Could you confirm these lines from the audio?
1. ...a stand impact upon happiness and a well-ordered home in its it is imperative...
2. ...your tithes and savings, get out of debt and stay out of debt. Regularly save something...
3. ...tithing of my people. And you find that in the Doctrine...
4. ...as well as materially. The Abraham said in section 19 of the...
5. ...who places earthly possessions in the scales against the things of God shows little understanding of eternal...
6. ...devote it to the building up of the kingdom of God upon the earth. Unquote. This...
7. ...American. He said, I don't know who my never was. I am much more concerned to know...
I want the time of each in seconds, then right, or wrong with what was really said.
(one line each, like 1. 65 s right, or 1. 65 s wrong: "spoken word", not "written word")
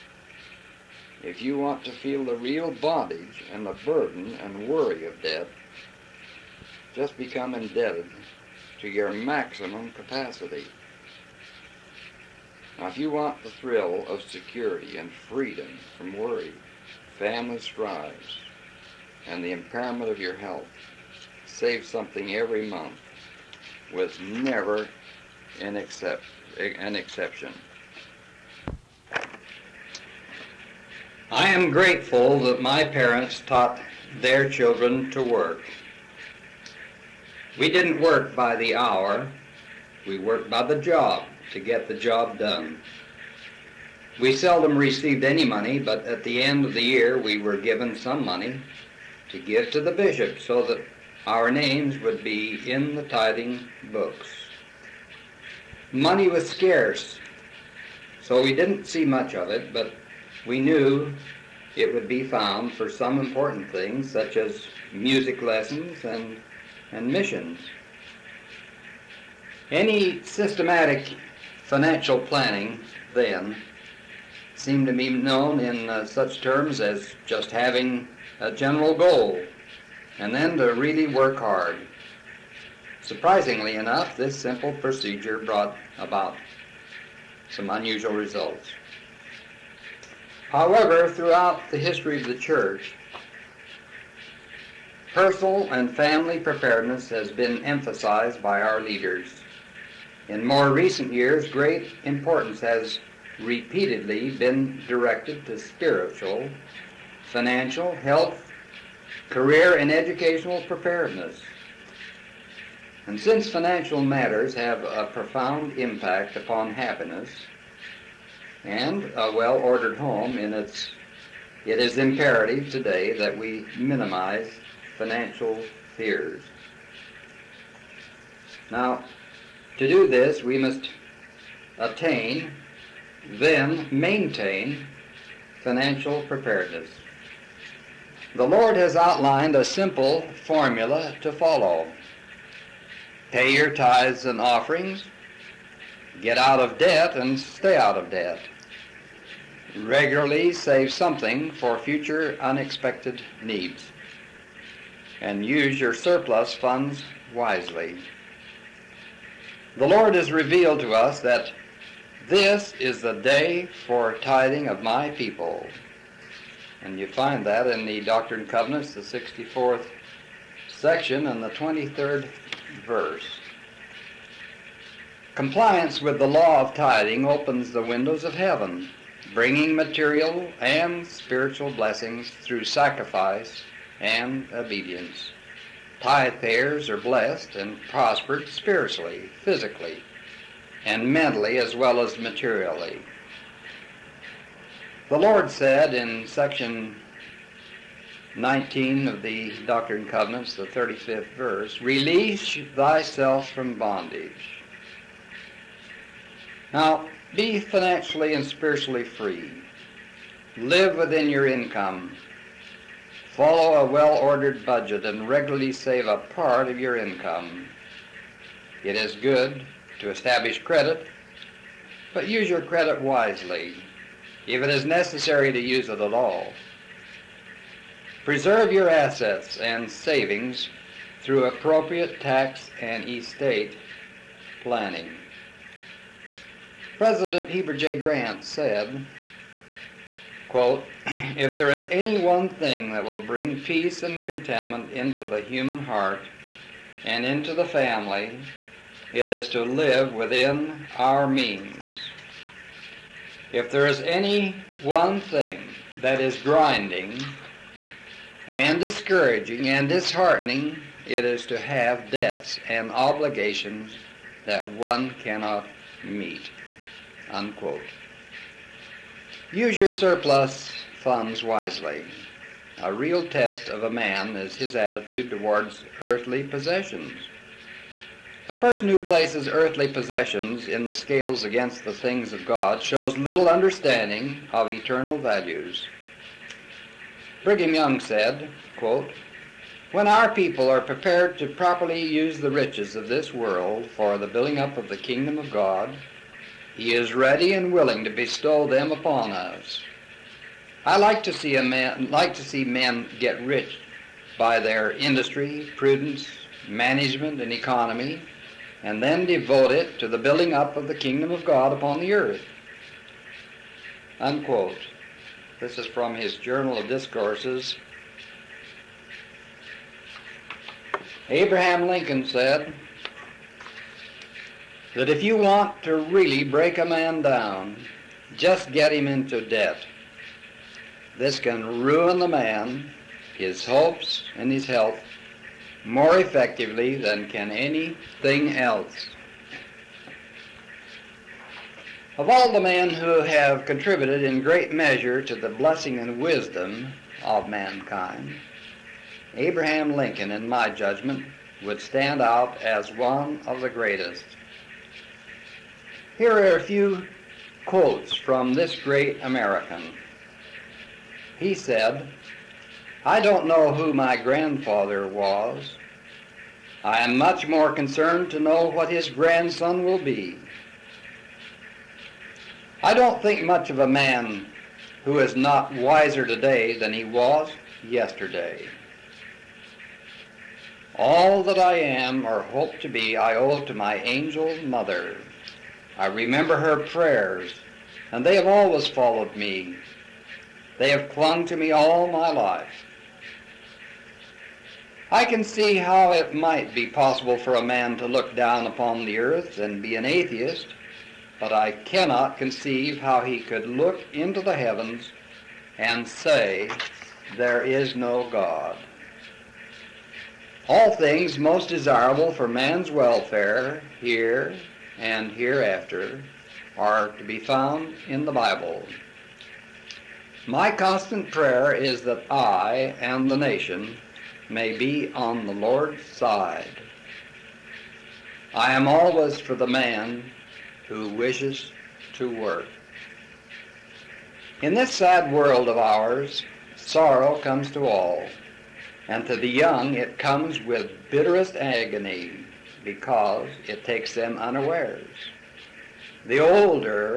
1. 114 s wrong: "profound", not "stand"
2. 143 s wrong: "offerings", not "savings"
3. 164 s right
4. 191 s wrong: "Lord", not "Abraham"
5. 278 s right
6. 309 s right
7. 359 s wrong: "grandfather", not "never".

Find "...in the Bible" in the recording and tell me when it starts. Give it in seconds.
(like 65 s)
418 s.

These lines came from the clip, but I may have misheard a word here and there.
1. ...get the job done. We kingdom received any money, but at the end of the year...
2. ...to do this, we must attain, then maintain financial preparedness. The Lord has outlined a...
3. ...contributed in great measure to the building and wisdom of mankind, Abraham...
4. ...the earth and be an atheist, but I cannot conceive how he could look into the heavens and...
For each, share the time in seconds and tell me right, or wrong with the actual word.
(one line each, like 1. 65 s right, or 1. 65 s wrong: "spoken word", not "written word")
1. 41 s wrong: "seldom", not "kingdom"
2. 129 s right
3. 343 s wrong: "blessing", not "building"
4. 399 s right.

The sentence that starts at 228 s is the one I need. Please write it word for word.
Preserve your assets and savings through appropriate tax and estate planning.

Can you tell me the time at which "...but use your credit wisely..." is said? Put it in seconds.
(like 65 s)
222 s.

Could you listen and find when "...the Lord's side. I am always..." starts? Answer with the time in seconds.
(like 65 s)
425 s.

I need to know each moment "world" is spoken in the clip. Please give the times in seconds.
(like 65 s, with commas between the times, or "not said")
293 s, 435 s.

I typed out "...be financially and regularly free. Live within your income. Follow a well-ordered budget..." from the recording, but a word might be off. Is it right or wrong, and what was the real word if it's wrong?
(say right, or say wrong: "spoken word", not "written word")
wrong: "spiritually", not "regularly".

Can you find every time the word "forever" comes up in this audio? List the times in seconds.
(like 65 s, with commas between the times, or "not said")
not said.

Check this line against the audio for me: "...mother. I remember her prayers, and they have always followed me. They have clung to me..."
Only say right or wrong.
right.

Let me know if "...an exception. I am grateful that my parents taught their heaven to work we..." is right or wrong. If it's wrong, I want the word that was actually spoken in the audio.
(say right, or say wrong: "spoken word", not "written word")
wrong: "children", not "heaven".